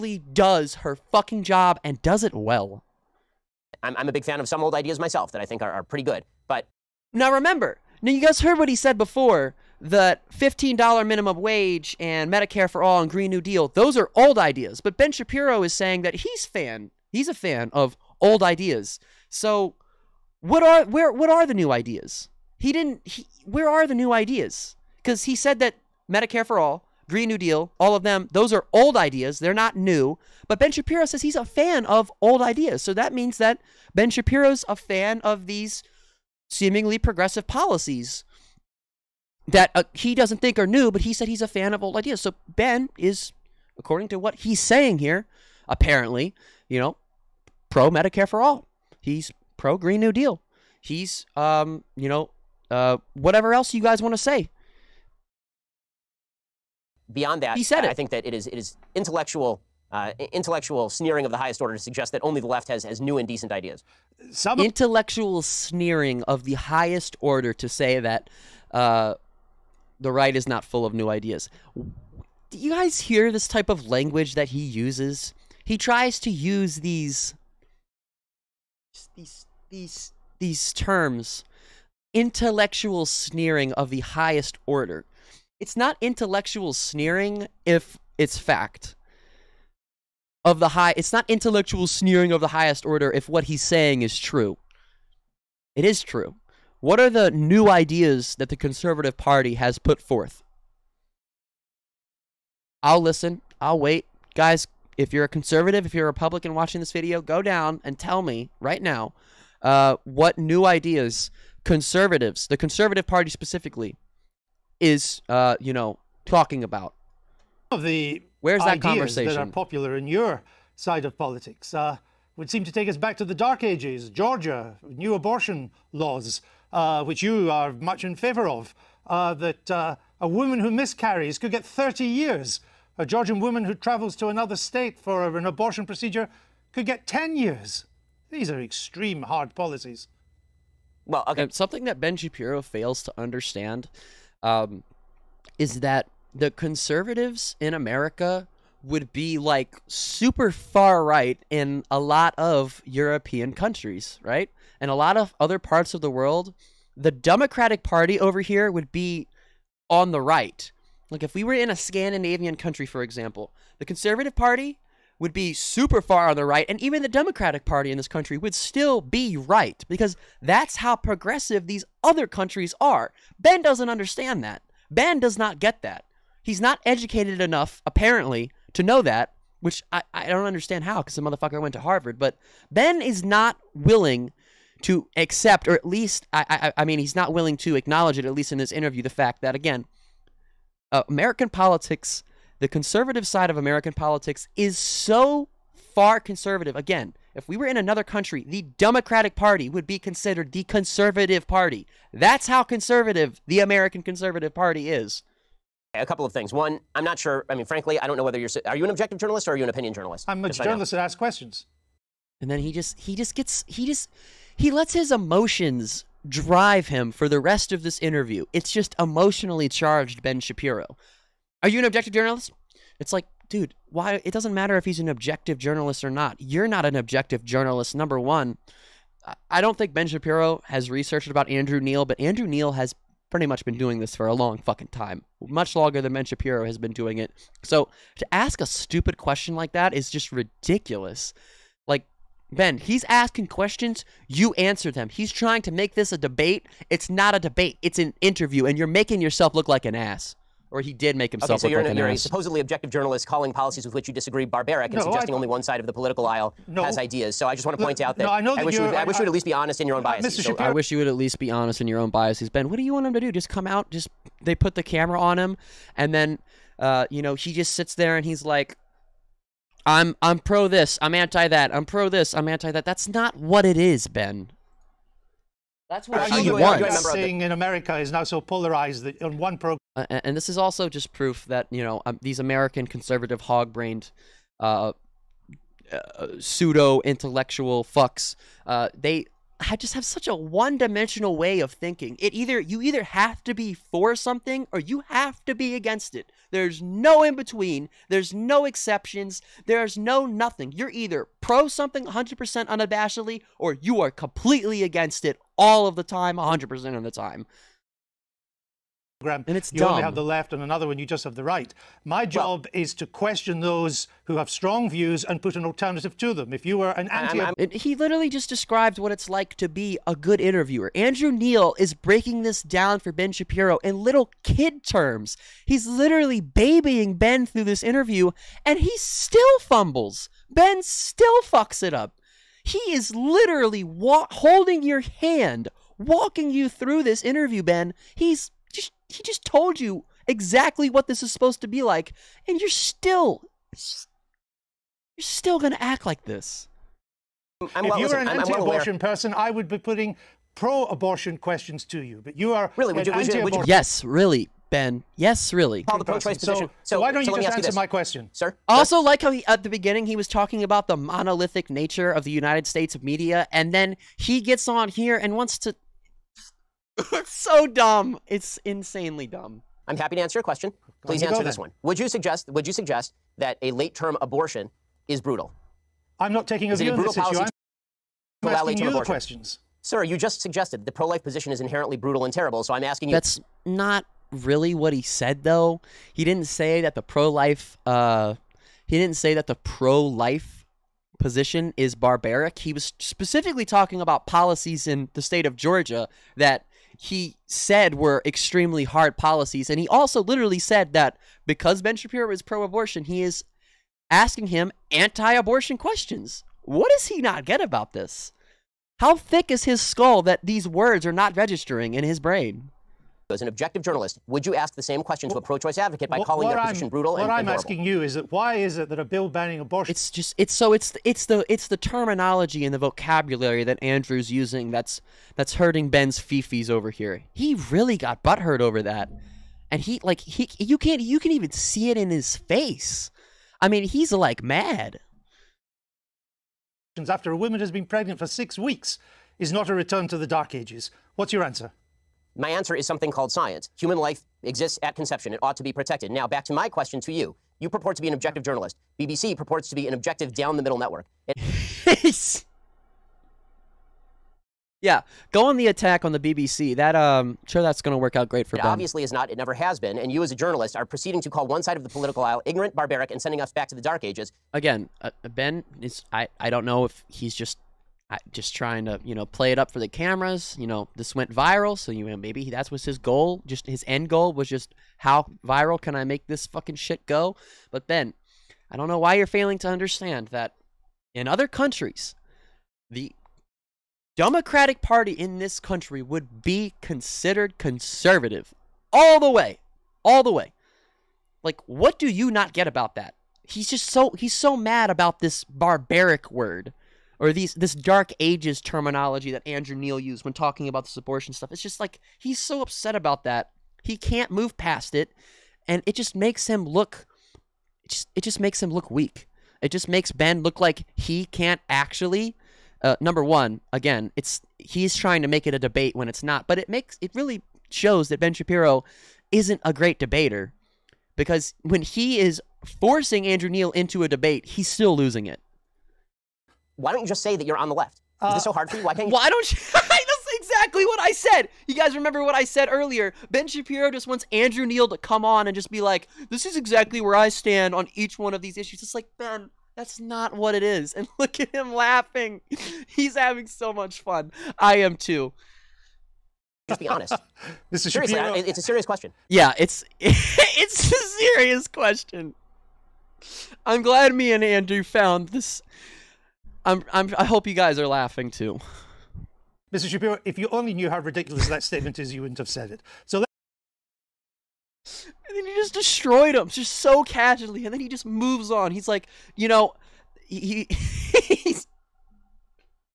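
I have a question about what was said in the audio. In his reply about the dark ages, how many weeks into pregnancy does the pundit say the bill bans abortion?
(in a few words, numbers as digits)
6 weeks.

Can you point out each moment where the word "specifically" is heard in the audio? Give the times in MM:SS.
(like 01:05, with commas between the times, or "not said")
01:53, 06:32.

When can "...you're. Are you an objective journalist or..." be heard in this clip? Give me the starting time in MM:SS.
03:28.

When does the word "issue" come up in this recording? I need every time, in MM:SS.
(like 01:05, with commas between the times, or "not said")
06:17, 08:58.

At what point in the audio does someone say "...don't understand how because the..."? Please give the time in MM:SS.
03:00.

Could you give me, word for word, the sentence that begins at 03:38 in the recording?
It's just emotionally charged Ben Shapiro.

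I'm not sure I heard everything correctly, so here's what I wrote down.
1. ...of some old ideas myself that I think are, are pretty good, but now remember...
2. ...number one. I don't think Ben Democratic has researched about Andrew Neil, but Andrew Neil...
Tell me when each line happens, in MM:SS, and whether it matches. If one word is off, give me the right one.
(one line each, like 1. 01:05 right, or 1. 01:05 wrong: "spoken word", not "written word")
1. 00:04 right
2. 03:47 wrong: "Shapiro", not "Democratic".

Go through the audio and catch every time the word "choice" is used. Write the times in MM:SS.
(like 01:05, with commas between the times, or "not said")
05:56, 06:55.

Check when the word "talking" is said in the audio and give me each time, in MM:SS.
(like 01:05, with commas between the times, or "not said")
01:56, 06:00, 06:33, 08:20.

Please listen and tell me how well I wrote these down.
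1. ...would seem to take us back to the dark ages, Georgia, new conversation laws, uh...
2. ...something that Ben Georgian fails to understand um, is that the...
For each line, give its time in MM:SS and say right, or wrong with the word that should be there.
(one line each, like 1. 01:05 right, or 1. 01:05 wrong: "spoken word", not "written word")
1. 02:02 wrong: "abortion", not "conversation"
2. 02:21 wrong: "Shapiro", not "Georgian".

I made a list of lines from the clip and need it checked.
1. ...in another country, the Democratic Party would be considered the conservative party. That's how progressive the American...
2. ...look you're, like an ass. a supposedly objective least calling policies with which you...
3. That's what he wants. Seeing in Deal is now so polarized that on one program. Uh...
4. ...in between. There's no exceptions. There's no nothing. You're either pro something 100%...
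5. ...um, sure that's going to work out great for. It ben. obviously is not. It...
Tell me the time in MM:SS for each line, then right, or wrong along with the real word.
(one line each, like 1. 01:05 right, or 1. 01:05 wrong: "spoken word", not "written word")
1. 03:17 wrong: "conservative", not "progressive"
2. 04:11 wrong: "journalist", not "least"
3. 04:35 wrong: "America", not "Deal"
4. 04:57 right
5. 07:36 right.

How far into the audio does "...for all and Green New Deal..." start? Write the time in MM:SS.
00:12.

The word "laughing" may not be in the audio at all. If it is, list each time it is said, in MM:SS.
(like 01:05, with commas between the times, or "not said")
09:01, 09:17.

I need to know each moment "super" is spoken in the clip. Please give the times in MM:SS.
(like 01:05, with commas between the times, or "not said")
02:29, 02:45.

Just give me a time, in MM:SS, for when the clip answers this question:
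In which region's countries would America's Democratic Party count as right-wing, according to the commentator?
02:41.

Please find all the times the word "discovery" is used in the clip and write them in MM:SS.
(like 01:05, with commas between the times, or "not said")
not said.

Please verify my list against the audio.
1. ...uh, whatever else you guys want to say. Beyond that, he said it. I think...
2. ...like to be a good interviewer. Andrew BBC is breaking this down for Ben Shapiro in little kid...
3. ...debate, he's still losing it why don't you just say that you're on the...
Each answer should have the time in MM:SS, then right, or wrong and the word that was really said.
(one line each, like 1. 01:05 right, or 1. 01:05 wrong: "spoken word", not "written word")
1. 00:52 right
2. 05:19 wrong: "Neil", not "BBC"
3. 08:44 right.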